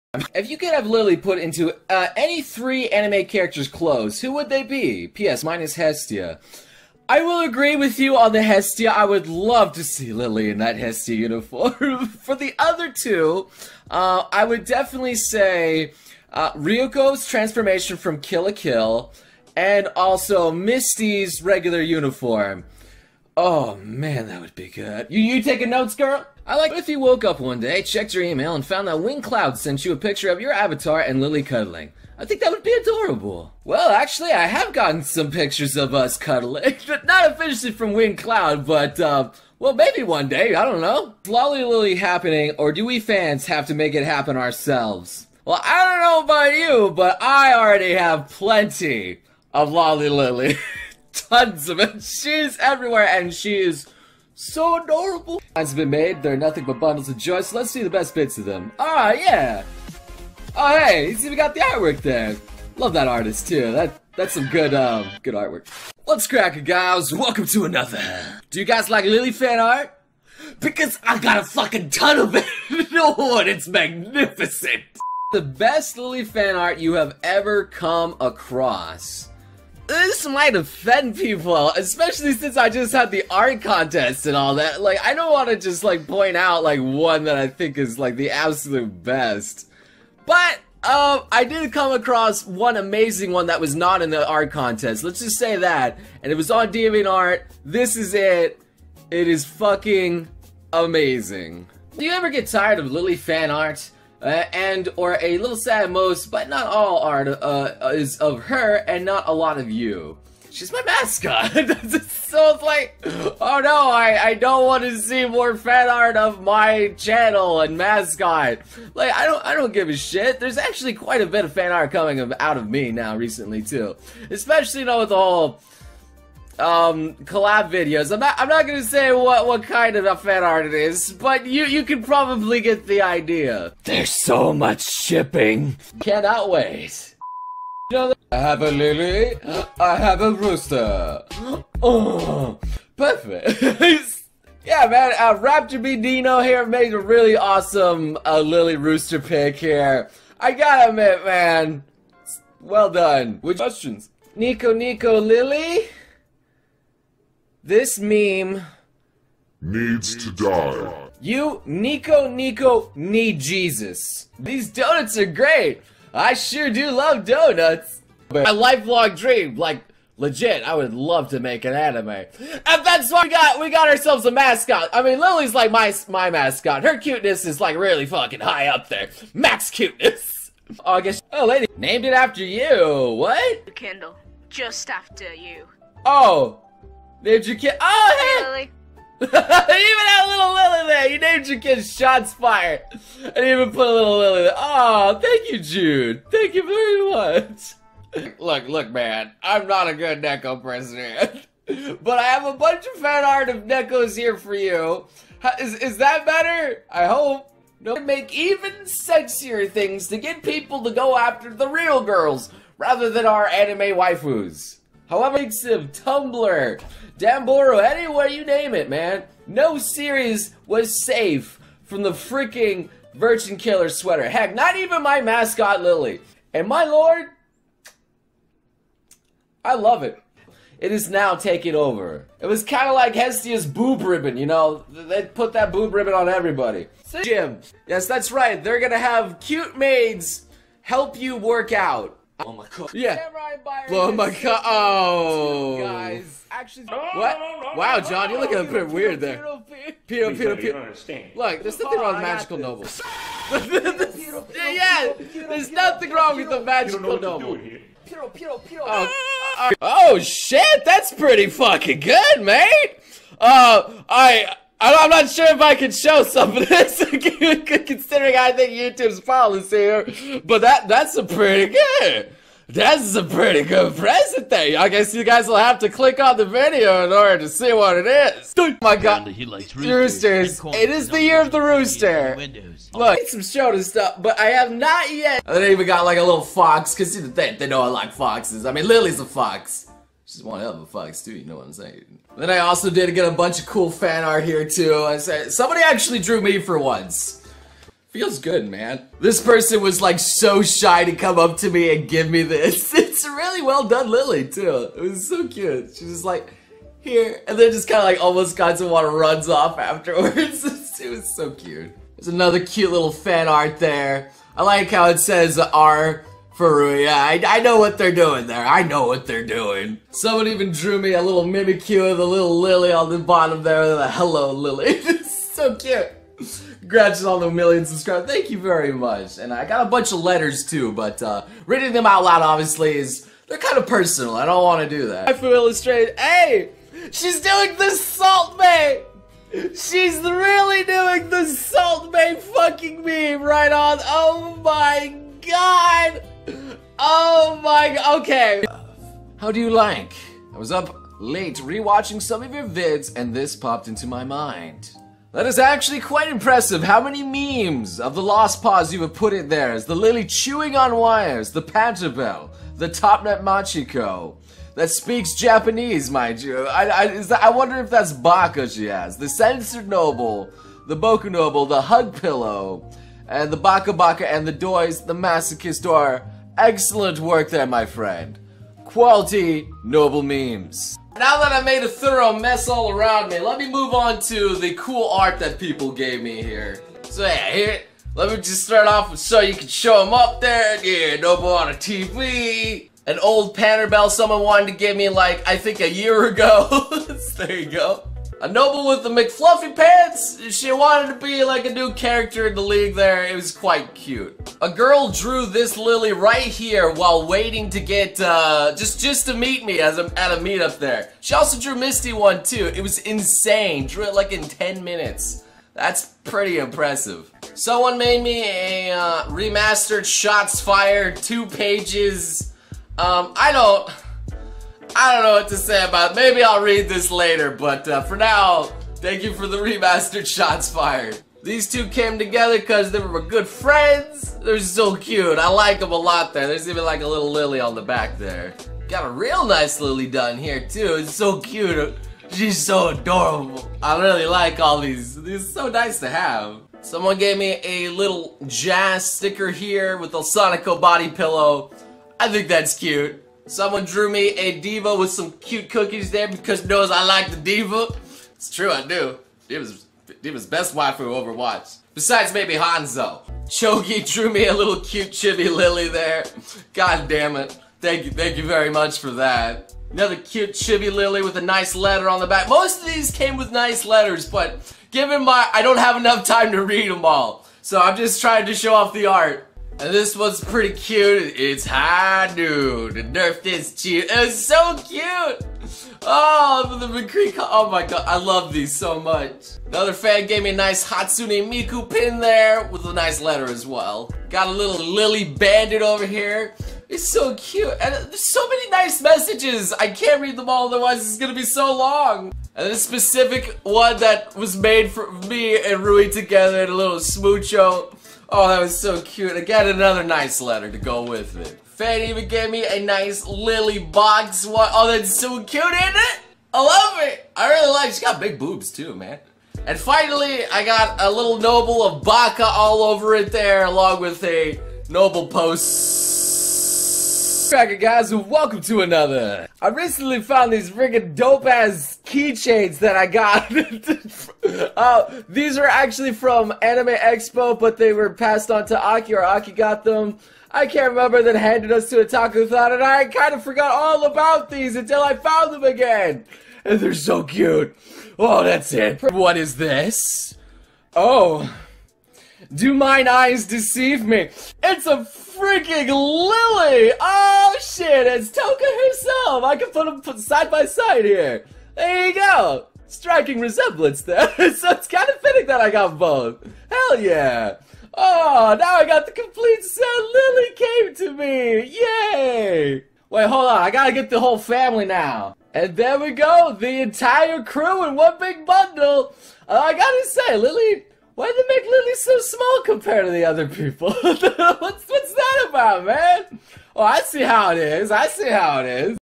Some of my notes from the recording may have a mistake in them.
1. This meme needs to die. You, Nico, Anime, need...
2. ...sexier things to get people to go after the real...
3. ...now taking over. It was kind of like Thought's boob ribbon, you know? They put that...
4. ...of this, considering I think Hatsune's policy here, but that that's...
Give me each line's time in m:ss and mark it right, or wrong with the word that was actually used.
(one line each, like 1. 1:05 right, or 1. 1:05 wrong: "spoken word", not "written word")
1. 2:37 wrong: "Nico", not "Anime"
2. 3:28 right
3. 3:51 wrong: "Hestia", not "Thought"
4. 4:26 wrong: "YouTube", not "Hatsune".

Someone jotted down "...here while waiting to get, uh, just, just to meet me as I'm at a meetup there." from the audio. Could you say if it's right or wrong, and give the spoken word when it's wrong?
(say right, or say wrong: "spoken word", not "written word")
right.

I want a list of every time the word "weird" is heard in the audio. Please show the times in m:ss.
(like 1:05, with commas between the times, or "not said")
4:08.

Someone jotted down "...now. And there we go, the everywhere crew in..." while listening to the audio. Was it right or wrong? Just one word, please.
wrong.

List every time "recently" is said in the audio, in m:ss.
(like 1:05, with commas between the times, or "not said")
2:03, 8:49.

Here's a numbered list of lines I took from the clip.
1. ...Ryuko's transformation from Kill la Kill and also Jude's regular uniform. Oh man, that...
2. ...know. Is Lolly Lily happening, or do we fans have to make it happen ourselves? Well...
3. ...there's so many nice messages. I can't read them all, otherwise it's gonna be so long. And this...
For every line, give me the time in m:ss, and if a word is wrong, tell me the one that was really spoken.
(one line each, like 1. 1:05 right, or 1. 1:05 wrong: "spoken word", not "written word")
1. 0:16 wrong: "Misty", not "Jude"
2. 0:40 right
3. 8:17 right.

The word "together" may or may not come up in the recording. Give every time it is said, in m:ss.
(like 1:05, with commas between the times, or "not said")
7:12, 8:26.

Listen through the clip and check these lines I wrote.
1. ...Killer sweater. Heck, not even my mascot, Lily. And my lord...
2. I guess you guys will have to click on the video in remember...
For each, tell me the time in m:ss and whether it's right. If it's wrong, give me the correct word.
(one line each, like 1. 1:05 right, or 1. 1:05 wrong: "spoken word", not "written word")
1. 3:43 right
2. 4:34 wrong: "order", not "remember".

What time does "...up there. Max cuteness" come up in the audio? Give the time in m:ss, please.
2:58.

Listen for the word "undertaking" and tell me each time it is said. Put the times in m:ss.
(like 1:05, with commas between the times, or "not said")
not said.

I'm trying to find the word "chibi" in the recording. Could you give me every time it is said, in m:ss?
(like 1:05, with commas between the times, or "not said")
7:45, 7:50.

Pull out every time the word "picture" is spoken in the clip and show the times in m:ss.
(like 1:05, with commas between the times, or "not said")
0:29, 0:35.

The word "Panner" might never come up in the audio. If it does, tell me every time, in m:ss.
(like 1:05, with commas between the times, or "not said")
6:33.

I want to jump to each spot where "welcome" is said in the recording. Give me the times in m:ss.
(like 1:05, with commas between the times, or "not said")
1:07, 8:48.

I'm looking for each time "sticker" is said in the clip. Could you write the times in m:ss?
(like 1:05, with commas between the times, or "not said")
7:29.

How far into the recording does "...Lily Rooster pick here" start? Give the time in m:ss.
2:28.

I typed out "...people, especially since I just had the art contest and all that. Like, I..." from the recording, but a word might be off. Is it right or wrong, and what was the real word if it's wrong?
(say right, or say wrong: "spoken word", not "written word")
right.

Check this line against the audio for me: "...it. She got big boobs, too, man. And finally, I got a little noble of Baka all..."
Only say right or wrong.
right.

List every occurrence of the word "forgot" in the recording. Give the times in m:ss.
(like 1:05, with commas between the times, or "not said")
9:03.